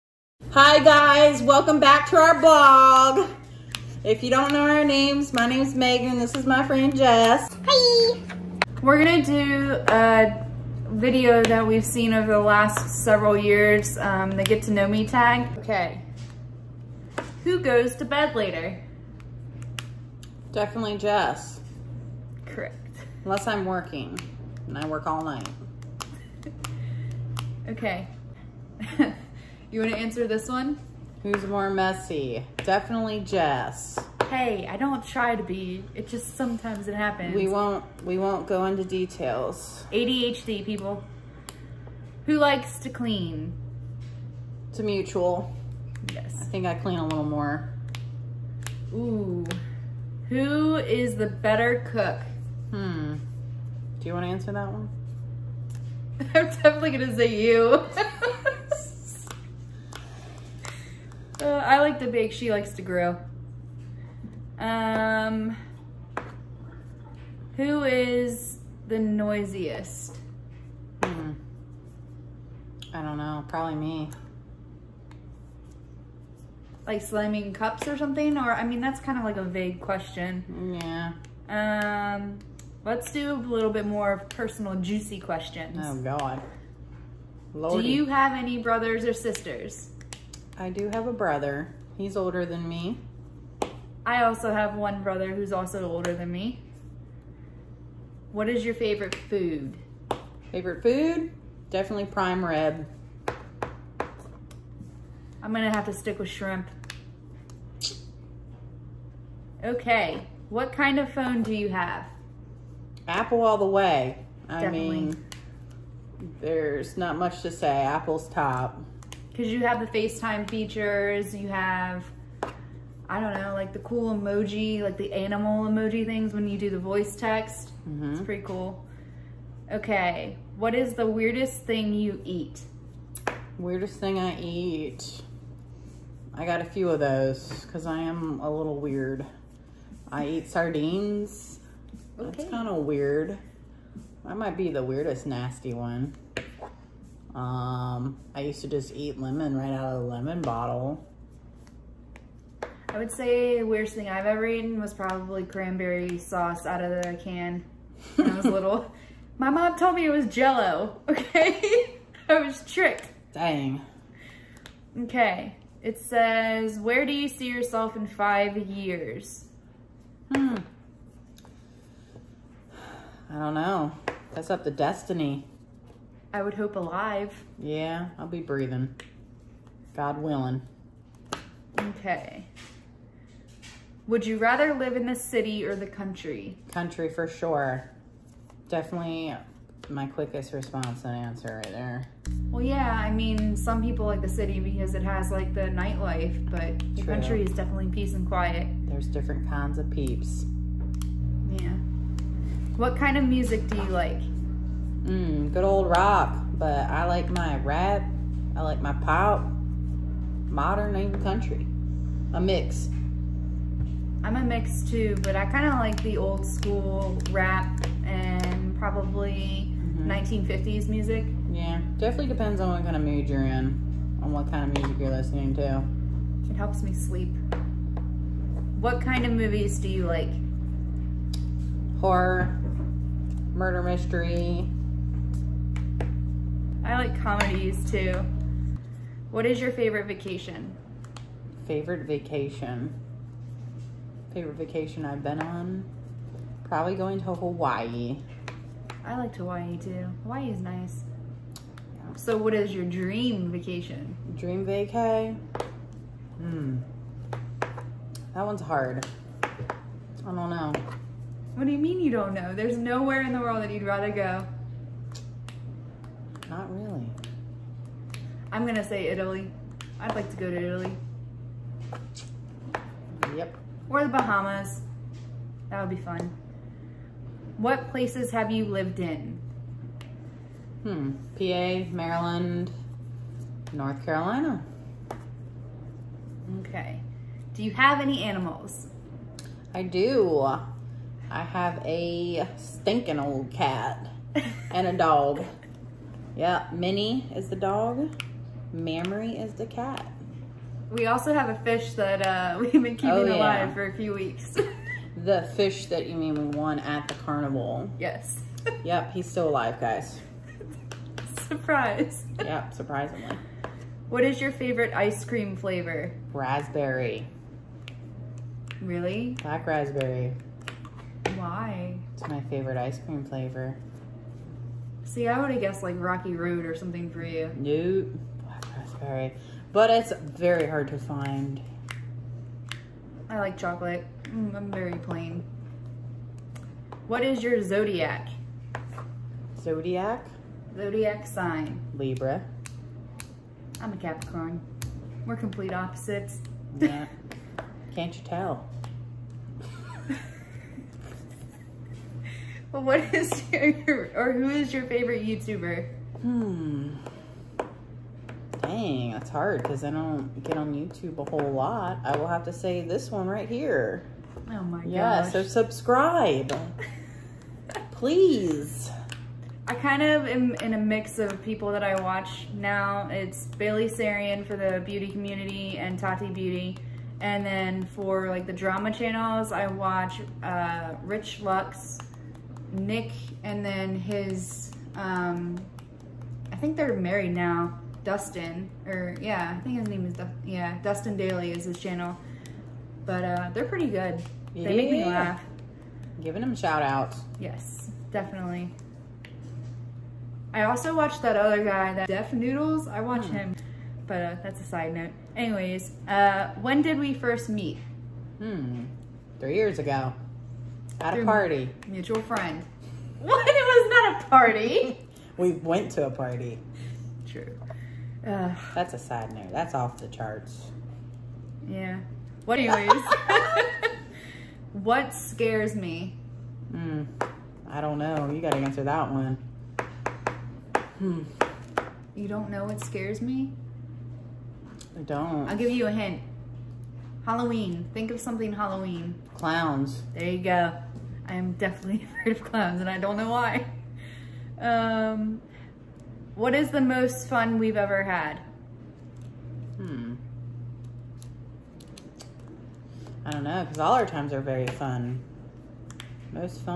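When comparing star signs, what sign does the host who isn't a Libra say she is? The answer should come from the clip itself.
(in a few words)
Capricorn.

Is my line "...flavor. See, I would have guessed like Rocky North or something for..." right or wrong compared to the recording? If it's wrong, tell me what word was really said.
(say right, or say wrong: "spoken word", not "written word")
wrong: "Road", not "North".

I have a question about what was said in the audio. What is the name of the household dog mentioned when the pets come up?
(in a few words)
Minnie.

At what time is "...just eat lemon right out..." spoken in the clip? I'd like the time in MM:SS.
02:28.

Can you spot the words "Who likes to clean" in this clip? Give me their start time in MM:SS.
00:42.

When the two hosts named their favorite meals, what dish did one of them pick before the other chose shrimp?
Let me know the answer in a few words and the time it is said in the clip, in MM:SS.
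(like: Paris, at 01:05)
Prime rib, at 01:42.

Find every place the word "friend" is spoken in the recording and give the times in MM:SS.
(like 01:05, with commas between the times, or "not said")
00:06, 06:52.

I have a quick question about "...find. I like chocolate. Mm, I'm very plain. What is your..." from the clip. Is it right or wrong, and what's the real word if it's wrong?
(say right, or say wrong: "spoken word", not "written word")
right.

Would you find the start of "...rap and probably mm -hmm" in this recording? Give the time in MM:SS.
03:37.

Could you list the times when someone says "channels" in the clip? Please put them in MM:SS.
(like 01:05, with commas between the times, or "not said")
06:18, 06:31.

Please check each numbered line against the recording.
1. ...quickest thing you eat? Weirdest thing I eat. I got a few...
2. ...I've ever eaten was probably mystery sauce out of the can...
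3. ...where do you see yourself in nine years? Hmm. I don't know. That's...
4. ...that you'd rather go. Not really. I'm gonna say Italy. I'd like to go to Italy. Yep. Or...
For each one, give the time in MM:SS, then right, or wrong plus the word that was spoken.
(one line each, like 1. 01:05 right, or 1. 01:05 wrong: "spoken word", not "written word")
1. 02:11 wrong: "weirdest", not "quickest"
2. 02:34 wrong: "cranberry", not "mystery"
3. 02:46 wrong: "five", not "nine"
4. 04:23 right.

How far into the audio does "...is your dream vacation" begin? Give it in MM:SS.
04:12.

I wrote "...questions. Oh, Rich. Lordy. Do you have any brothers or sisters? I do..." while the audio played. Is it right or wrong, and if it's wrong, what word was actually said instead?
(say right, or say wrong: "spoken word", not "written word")
wrong: "God", not "Rich".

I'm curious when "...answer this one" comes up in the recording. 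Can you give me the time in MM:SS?
00:29.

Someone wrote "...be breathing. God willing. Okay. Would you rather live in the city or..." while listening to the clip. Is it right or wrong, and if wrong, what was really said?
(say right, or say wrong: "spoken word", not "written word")
right.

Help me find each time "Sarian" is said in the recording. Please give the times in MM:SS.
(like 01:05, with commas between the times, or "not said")
06:13.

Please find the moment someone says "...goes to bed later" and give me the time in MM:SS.
00:17.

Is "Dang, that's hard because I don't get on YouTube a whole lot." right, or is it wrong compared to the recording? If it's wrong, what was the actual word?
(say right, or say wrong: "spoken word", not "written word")
right.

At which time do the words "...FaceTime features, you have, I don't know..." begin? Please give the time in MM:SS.
01:59.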